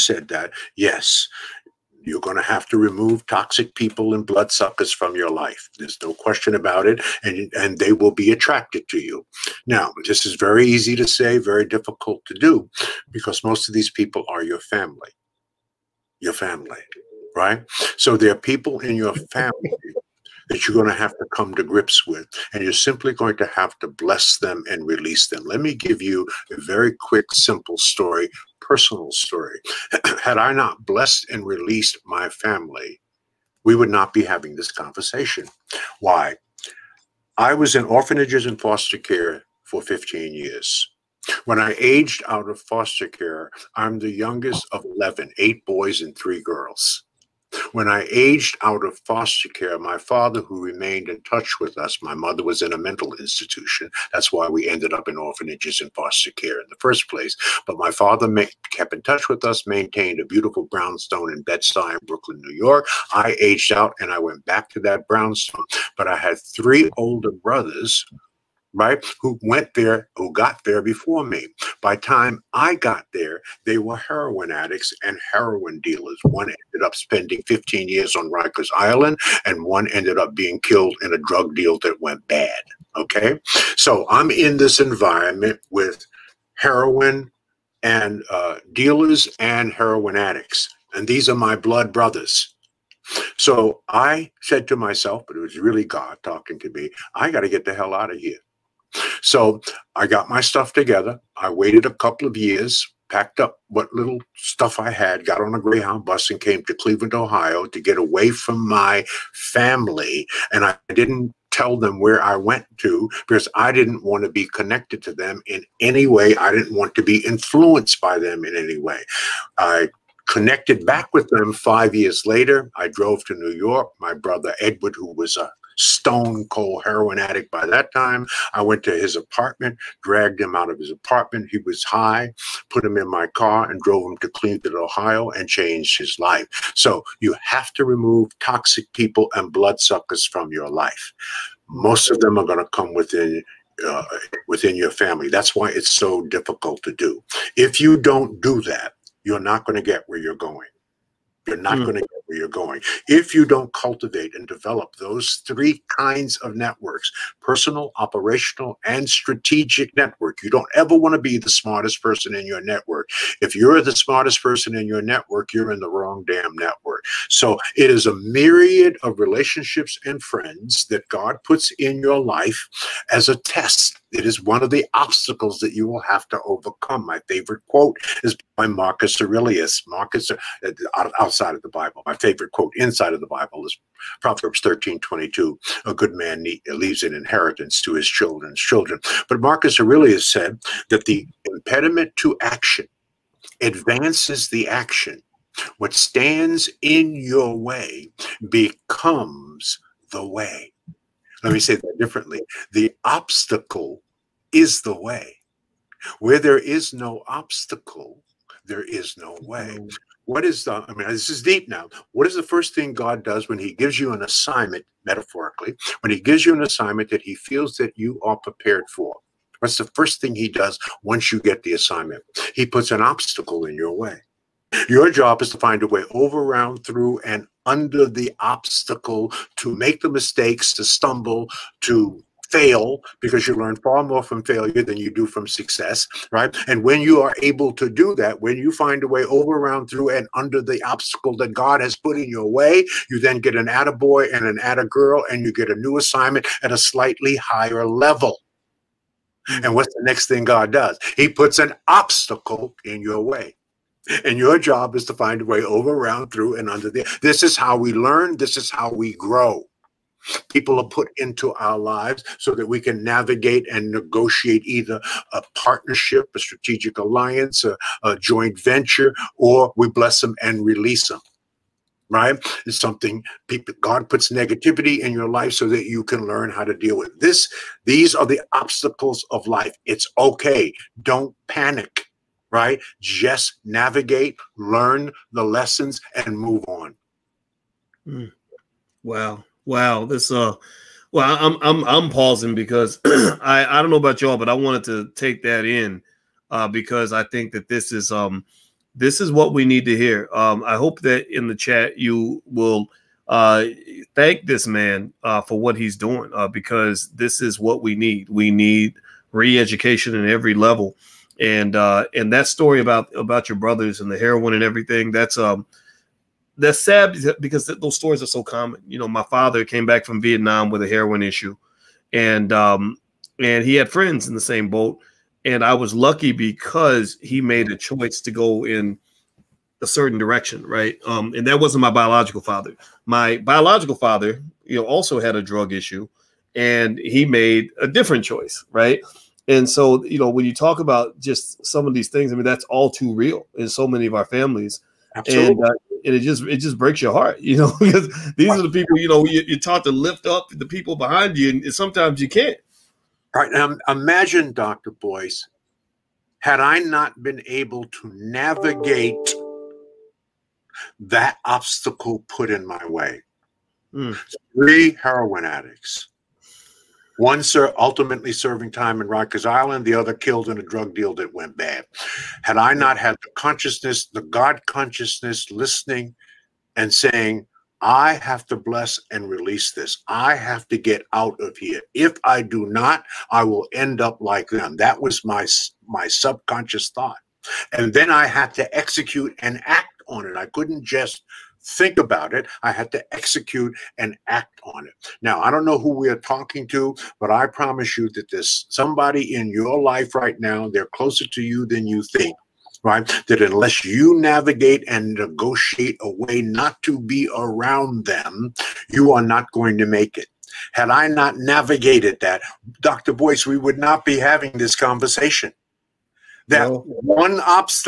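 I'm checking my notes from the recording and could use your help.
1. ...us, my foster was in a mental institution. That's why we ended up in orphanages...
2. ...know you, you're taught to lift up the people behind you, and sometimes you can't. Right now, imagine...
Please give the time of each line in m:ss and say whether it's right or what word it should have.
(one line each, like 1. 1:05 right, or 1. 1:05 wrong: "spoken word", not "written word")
1. 0:51 wrong: "mother", not "foster"
2. 5:49 right.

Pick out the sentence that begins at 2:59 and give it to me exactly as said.
Marcus, uh, uh, I'll outside of the Bible.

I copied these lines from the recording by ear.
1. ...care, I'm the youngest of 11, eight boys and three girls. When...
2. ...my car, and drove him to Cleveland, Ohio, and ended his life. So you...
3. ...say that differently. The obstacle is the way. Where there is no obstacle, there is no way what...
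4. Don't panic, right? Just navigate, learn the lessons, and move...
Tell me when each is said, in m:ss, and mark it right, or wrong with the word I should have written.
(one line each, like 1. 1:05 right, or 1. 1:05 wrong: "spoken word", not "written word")
1. 0:43 right
2. 2:13 wrong: "changed", not "ended"
3. 3:21 right
4. 4:41 right.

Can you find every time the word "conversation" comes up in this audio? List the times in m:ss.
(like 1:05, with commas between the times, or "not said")
0:34, 6:54.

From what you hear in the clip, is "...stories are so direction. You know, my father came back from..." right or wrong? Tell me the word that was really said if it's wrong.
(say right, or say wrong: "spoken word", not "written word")
wrong: "common", not "direction".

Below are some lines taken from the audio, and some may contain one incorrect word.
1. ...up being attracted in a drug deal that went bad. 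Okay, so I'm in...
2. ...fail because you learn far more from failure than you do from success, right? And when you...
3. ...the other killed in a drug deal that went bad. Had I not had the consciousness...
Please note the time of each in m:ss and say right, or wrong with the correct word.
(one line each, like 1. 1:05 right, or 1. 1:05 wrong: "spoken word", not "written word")
1. 1:20 wrong: "killed", not "attracted"
2. 3:52 right
3. 6:09 right.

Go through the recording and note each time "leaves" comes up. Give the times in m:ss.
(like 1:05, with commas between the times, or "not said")
3:06.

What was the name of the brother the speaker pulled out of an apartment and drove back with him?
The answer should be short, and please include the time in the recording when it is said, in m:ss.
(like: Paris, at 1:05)
Edward, at 2:04.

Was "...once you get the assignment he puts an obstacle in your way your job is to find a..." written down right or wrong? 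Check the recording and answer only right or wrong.
right.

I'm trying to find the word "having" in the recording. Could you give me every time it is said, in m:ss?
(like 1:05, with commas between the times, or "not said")
0:34, 6:54.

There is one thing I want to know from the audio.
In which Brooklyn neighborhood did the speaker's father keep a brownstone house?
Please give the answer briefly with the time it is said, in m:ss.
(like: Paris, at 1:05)
Bed-Stuy, at 1:01.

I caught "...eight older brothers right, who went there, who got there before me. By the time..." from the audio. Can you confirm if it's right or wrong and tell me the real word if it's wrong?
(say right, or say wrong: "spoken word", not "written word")
wrong: "three", not "eight".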